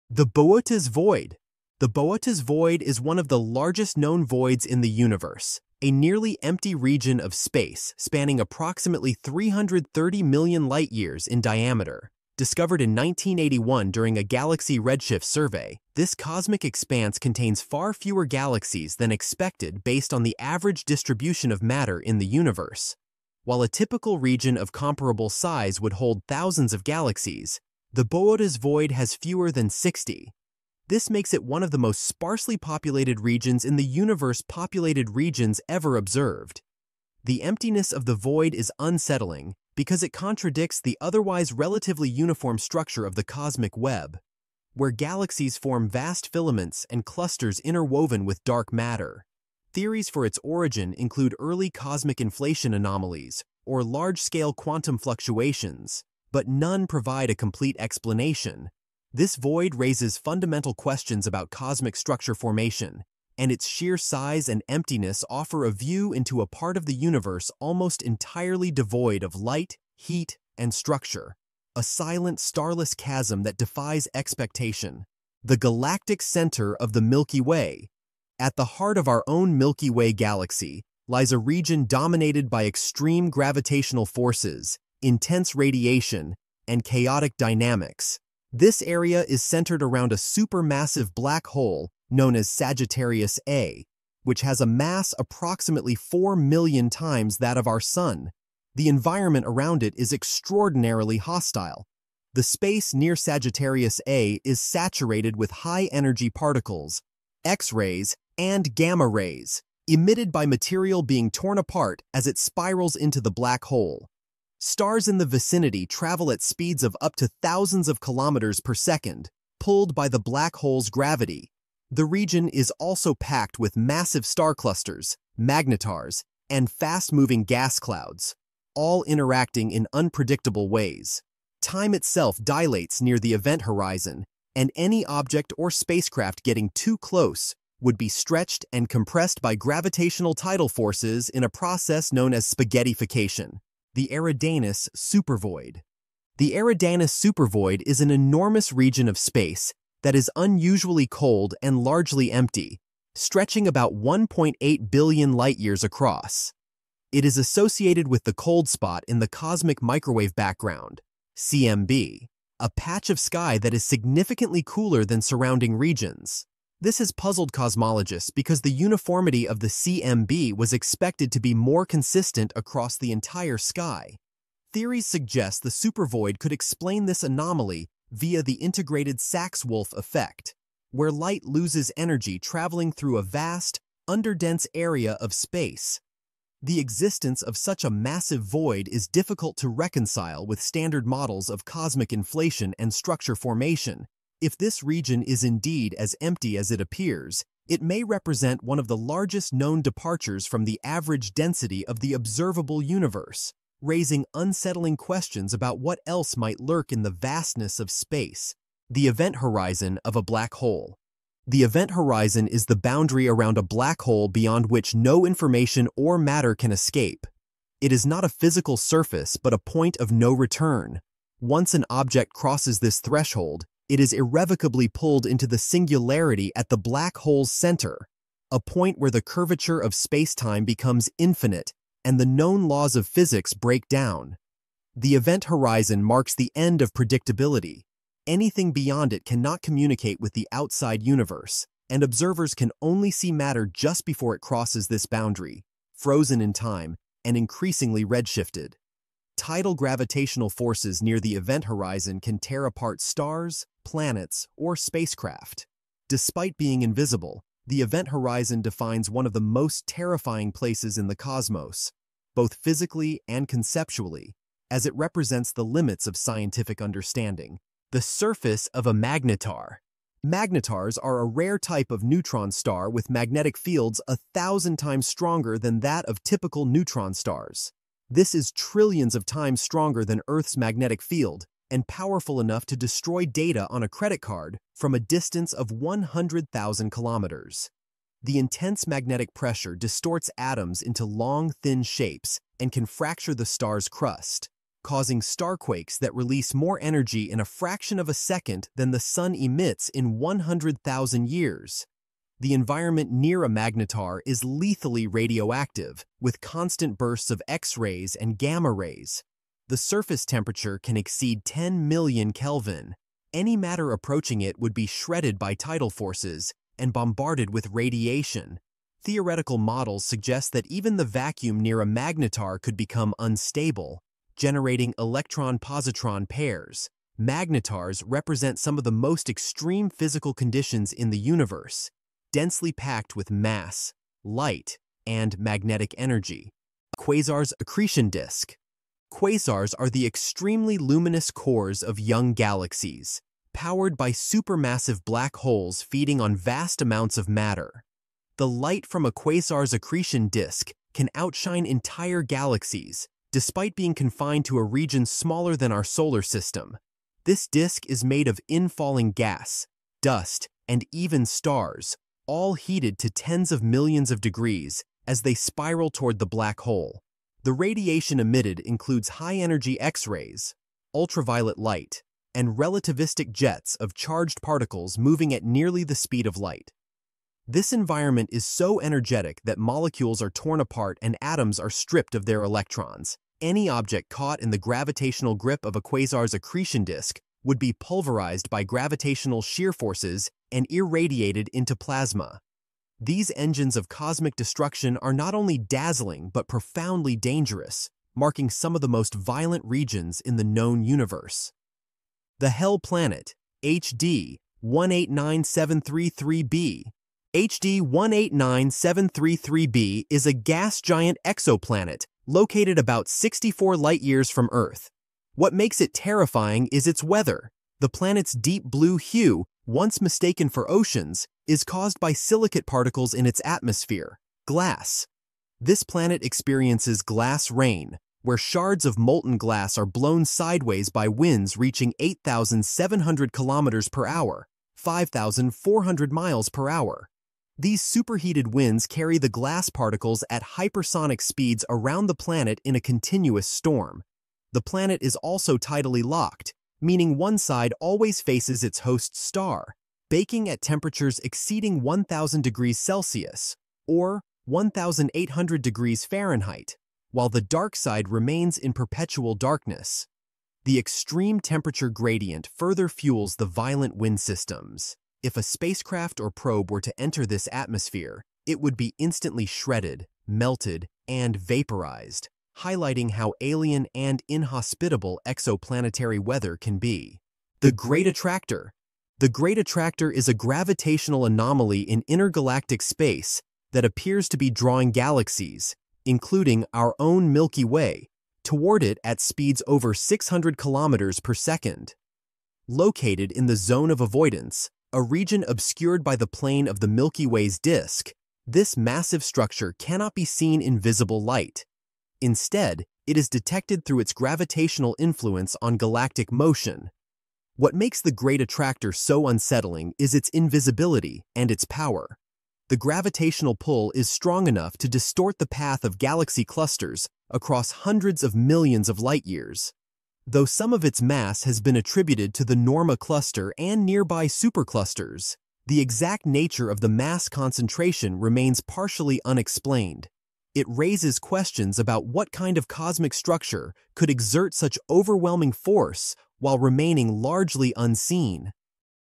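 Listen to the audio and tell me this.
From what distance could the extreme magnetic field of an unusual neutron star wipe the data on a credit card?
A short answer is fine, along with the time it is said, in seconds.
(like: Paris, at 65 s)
100,000 kilometers, at 285 s.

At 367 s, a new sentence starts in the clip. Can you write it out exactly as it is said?
The radiation emitted includes high-energy X-rays, ultraviolet light, and relativistic jets of charged particles moving at nearly the speed of light.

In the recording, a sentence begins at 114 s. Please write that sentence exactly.
Stars in the vicinity travel at speeds of up to thousands of kilometers per second, pulled by the black hole's gravity.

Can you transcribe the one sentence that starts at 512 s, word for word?
The gravitational pull is strong enough to distort the path of galaxy clusters across hundreds of millions of light years.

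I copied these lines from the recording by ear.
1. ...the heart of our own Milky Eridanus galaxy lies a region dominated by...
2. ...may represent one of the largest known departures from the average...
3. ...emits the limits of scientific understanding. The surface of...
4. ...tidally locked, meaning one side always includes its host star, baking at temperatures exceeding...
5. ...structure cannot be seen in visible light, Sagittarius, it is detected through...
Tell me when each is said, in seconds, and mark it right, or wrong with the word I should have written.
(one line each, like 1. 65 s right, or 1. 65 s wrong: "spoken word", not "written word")
1. 78 s wrong: "Way", not "Eridanus"
2. 197 s right
3. 264 s wrong: "represents", not "emits"
4. 445 s wrong: "faces", not "includes"
5. 499 s wrong: "Instead", not "Sagittarius".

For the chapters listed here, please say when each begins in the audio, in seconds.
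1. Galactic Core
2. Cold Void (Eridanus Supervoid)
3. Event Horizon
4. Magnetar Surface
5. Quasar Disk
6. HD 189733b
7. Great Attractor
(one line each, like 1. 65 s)
1. 76 s
2. 145 s
3. 209 s
4. 269 s
5. 338 s
6. 406 s
7. 478 s.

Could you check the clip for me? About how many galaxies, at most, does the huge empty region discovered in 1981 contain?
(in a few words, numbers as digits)
fewer than 60.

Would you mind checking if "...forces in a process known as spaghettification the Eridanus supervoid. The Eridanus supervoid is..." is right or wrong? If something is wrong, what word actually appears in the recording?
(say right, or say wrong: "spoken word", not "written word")
right.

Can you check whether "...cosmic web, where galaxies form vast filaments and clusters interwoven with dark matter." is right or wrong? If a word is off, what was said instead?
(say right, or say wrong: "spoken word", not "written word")
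right.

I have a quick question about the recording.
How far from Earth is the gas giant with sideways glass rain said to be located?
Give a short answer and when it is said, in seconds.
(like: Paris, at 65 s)
64 light-years, at 413 s.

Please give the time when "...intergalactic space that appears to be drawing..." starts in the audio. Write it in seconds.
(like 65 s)
482 s.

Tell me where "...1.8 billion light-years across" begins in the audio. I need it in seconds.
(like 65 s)
153 s.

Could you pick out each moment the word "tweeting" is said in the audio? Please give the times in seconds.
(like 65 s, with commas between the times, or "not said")
not said.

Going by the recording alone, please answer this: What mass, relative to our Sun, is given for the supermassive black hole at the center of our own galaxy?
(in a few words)
4 million times.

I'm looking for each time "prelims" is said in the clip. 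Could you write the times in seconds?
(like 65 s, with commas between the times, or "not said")
not said.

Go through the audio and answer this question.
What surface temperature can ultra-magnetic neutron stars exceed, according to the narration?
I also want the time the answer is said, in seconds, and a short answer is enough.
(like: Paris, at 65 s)
10 million Kelvin, at 311 s.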